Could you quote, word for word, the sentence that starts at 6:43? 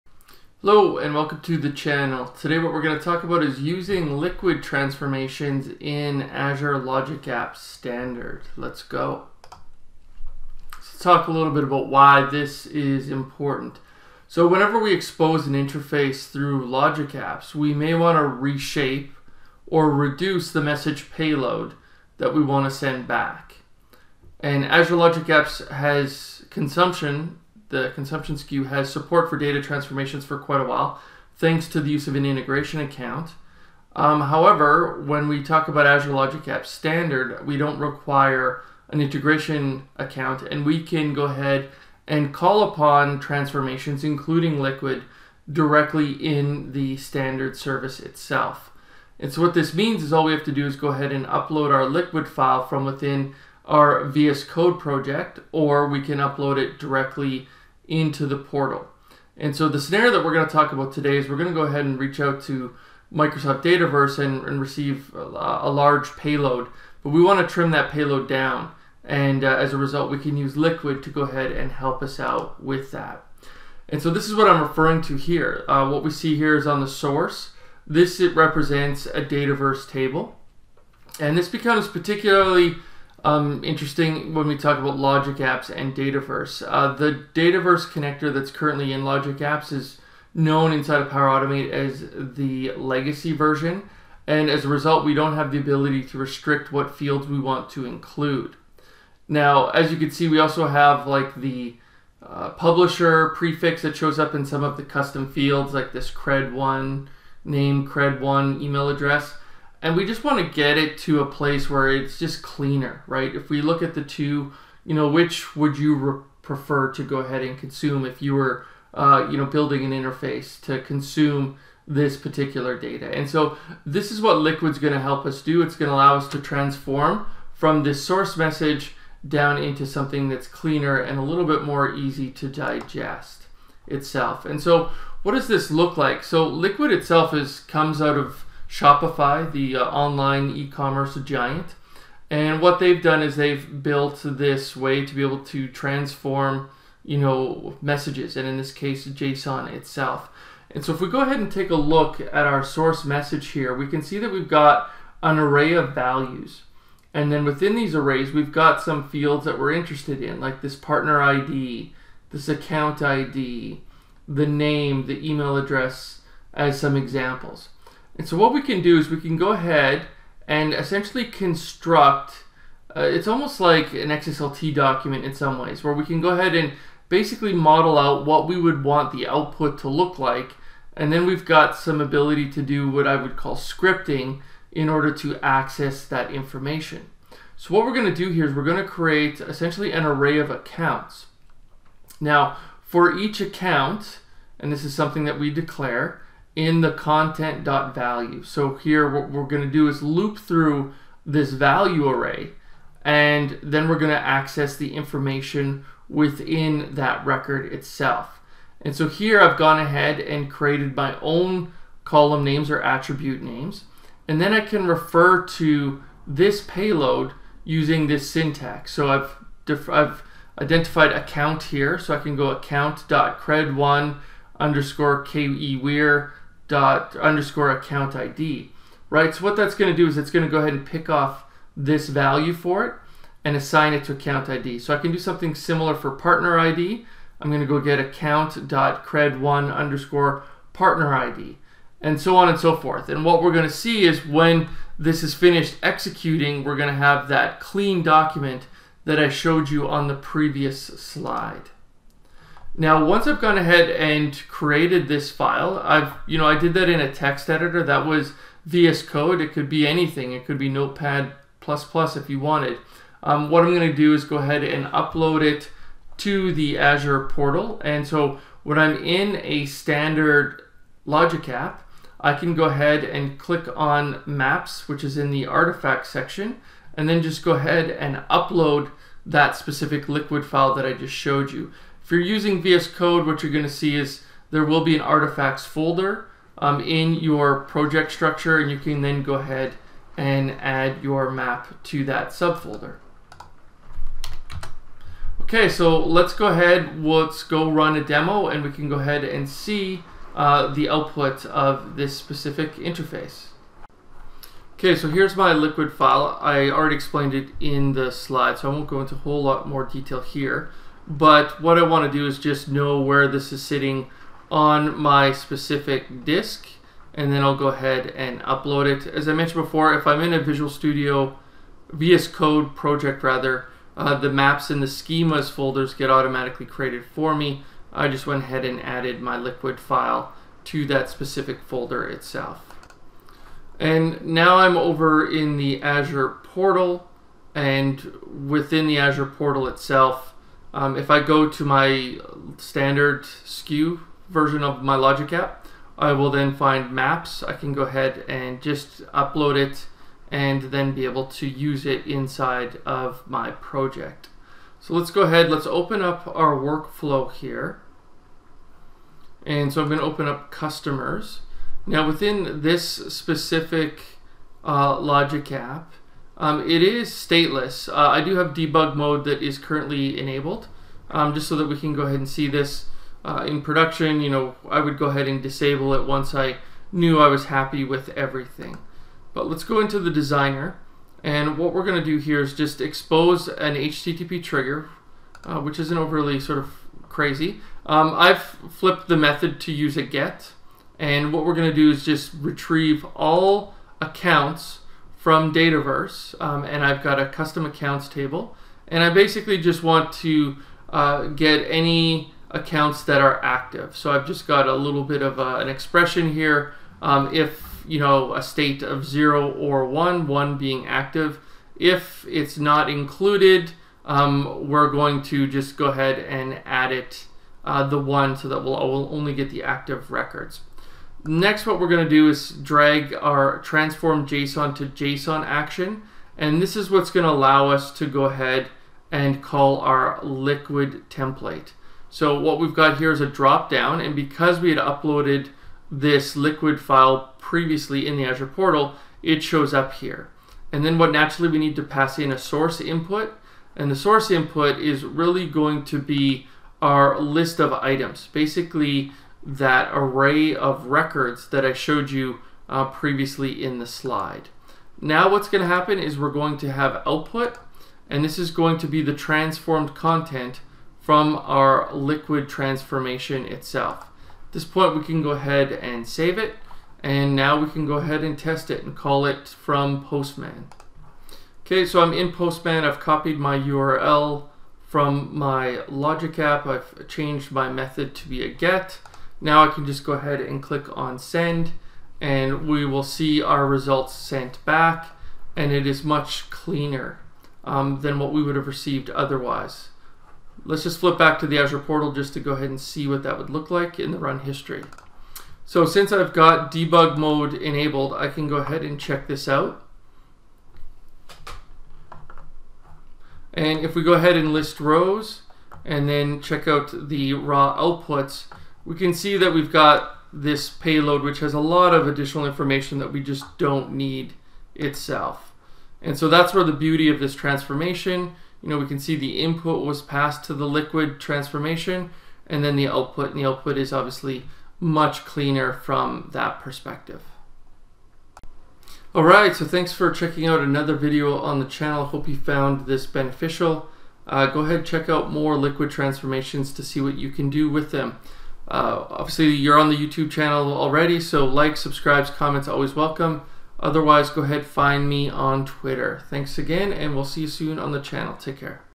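So I've just got a little bit of a, uh, an expression here.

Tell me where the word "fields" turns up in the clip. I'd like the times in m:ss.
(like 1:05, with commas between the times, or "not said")
1:36, 1:45, 2:39.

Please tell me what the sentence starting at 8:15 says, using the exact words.
So since I've got debug mode enabled, I can go ahead and check this out.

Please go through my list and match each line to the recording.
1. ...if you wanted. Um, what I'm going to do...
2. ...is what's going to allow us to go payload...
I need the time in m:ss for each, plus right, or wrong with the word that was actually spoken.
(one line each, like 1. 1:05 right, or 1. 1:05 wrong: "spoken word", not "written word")
1. 4:22 right
2. 7:06 wrong: "ahead", not "payload".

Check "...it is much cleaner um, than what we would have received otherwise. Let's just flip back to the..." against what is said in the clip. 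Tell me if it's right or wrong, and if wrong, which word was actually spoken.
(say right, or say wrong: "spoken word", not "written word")
right.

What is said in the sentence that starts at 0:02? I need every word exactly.
Today what we're going to talk about is using liquid transformations in Azure Logic Apps Standard.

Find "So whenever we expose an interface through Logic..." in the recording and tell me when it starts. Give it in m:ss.
0:14.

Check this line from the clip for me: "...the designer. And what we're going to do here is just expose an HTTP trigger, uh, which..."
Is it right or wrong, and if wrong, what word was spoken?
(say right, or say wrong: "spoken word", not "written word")
right.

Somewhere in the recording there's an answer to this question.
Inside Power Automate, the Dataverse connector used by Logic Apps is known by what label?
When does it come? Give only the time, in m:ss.
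1:32.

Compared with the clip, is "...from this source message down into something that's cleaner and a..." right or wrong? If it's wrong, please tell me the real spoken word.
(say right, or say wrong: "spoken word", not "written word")
right.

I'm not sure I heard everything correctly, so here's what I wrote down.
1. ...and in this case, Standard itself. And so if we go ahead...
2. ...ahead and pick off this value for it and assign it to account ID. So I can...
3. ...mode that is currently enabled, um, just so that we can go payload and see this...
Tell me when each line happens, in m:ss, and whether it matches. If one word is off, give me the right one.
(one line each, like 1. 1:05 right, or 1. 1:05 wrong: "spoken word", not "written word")
1. 2:28 wrong: "JSON", not "Standard"
2. 3:50 right
3. 6:08 wrong: "ahead", not "payload".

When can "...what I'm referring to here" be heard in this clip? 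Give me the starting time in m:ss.
1:14.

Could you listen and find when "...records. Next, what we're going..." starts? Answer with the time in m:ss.
7:00.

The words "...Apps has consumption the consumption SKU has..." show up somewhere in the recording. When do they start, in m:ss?
0:25.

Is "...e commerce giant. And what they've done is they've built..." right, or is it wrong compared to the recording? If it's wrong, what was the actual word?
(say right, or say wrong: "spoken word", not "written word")
right.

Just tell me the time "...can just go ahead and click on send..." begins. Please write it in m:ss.
7:59.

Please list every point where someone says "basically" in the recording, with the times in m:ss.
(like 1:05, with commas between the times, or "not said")
2:57, 6:39, 7:28.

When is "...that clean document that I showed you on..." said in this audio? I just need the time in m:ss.
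4:07.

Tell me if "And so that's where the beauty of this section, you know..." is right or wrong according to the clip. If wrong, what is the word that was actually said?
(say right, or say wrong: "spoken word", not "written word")
wrong: "transformation", not "section".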